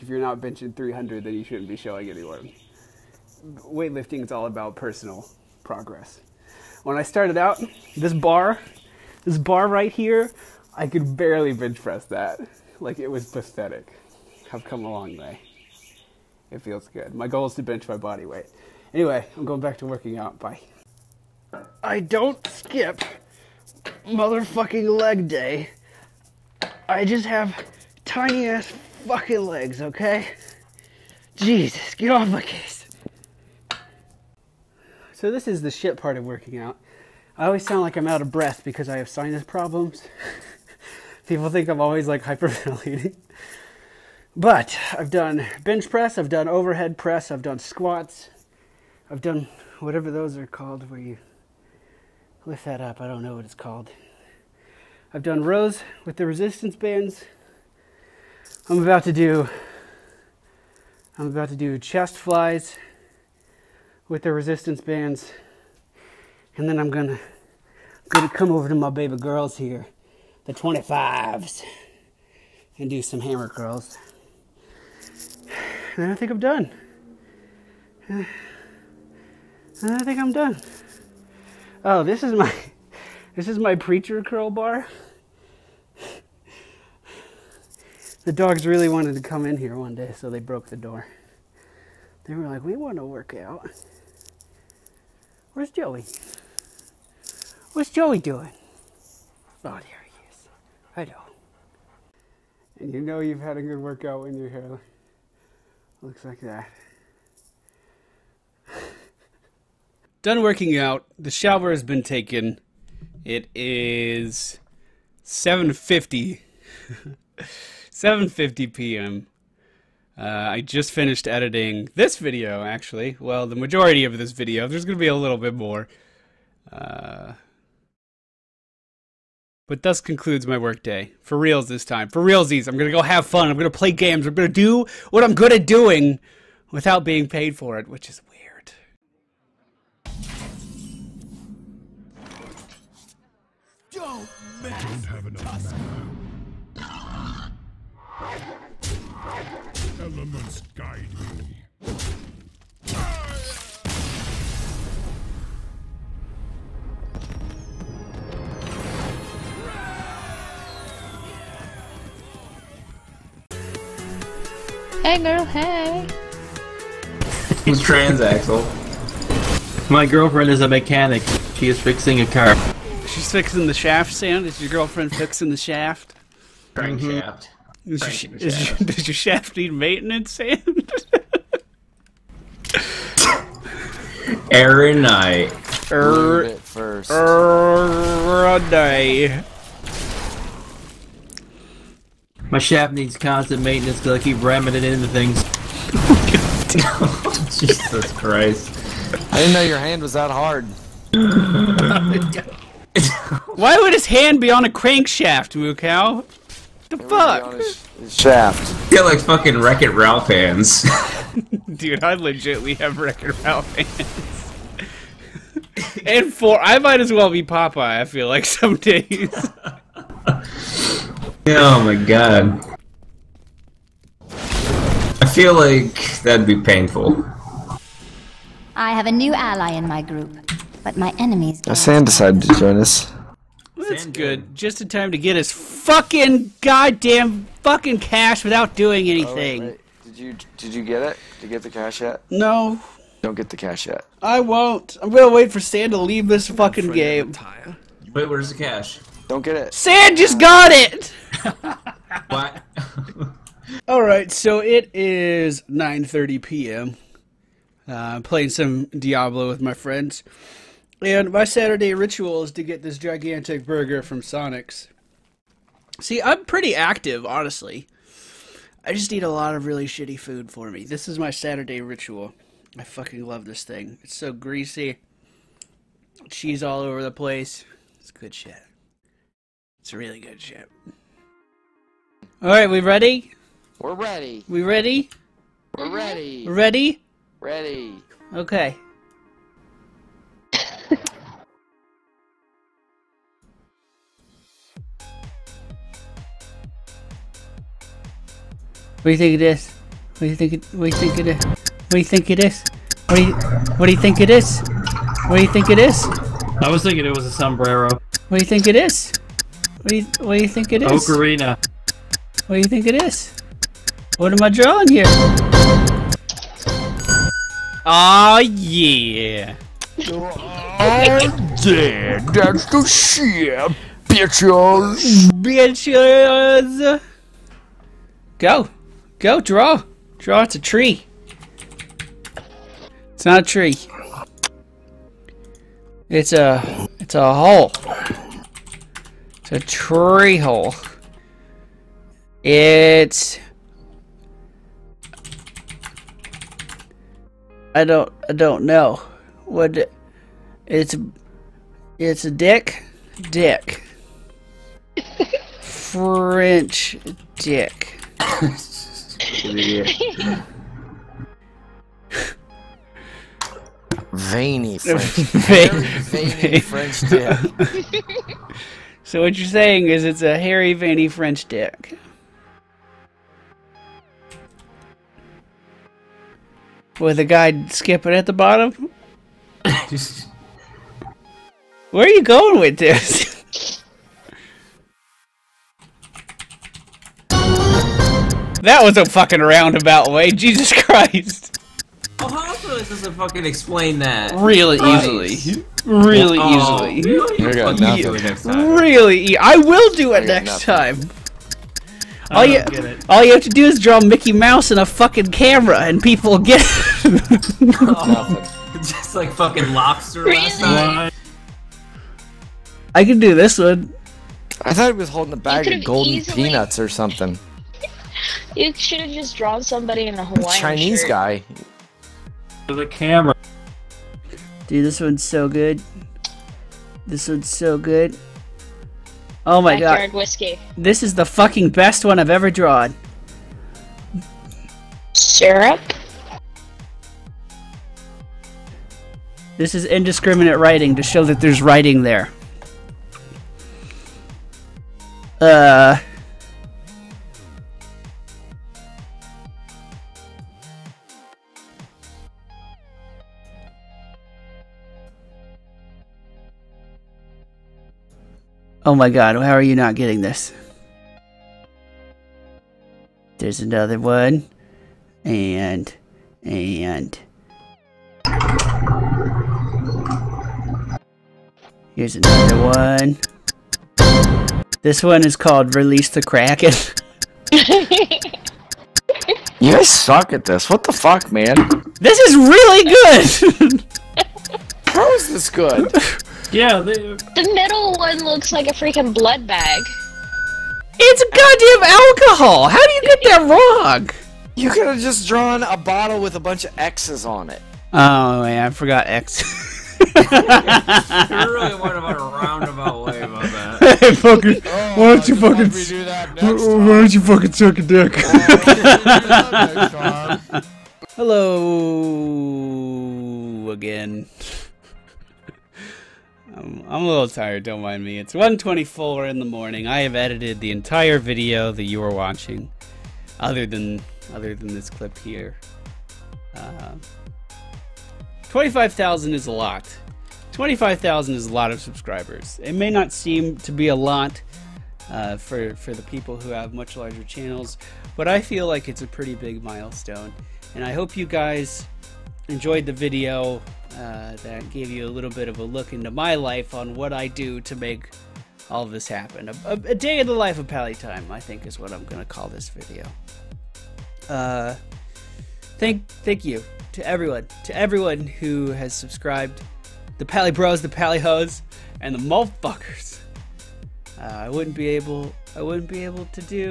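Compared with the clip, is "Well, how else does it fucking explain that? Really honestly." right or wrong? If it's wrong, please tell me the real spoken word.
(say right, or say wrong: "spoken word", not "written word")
wrong: "easily", not "honestly".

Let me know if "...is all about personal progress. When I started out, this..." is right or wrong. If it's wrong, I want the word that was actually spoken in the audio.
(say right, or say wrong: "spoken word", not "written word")
right.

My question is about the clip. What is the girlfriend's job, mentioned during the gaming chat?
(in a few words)
Mechanic.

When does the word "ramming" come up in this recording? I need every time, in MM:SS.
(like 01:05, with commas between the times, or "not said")
03:14.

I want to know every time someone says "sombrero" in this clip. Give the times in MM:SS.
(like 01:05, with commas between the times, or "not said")
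05:07.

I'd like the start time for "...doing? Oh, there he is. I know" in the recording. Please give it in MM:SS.
01:38.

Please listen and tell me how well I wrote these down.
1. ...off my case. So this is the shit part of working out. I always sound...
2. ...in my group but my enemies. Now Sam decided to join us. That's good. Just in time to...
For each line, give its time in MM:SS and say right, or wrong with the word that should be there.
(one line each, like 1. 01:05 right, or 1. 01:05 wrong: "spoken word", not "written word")
1. 00:32 right
2. 03:49 right.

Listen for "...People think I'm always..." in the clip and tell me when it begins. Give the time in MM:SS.
00:41.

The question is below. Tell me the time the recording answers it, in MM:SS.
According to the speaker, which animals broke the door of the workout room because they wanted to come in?
01:28.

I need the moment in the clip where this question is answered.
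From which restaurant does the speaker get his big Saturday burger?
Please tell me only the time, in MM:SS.
04:24.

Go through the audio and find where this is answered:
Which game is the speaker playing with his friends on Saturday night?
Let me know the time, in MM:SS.
04:18.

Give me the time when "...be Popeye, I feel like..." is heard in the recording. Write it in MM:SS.
03:37.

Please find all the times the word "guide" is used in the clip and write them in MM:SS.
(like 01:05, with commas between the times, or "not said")
02:30.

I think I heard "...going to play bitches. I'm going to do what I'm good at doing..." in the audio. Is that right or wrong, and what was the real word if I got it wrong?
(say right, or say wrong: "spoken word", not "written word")
wrong: "games", not "bitches".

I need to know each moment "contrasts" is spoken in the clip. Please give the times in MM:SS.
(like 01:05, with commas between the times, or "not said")
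not said.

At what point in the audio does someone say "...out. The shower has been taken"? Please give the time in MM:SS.
01:50.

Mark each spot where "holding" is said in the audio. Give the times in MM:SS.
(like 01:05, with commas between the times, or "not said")
06:55.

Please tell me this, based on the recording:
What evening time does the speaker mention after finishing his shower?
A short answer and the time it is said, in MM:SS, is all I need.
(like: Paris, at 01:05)
7:50 p.m., at 01:57.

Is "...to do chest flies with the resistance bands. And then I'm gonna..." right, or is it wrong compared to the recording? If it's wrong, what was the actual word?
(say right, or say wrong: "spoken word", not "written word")
right.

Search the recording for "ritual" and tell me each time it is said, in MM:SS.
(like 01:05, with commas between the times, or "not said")
04:21, 04:31.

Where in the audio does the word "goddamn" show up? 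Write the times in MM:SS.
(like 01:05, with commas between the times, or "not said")
03:56, 08:11.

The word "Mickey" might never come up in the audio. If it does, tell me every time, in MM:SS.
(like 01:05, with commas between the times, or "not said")
06:44.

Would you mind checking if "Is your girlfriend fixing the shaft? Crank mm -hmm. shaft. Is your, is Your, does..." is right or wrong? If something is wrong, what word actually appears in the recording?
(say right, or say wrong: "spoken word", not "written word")
right.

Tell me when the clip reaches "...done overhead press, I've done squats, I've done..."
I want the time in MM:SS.
00:46.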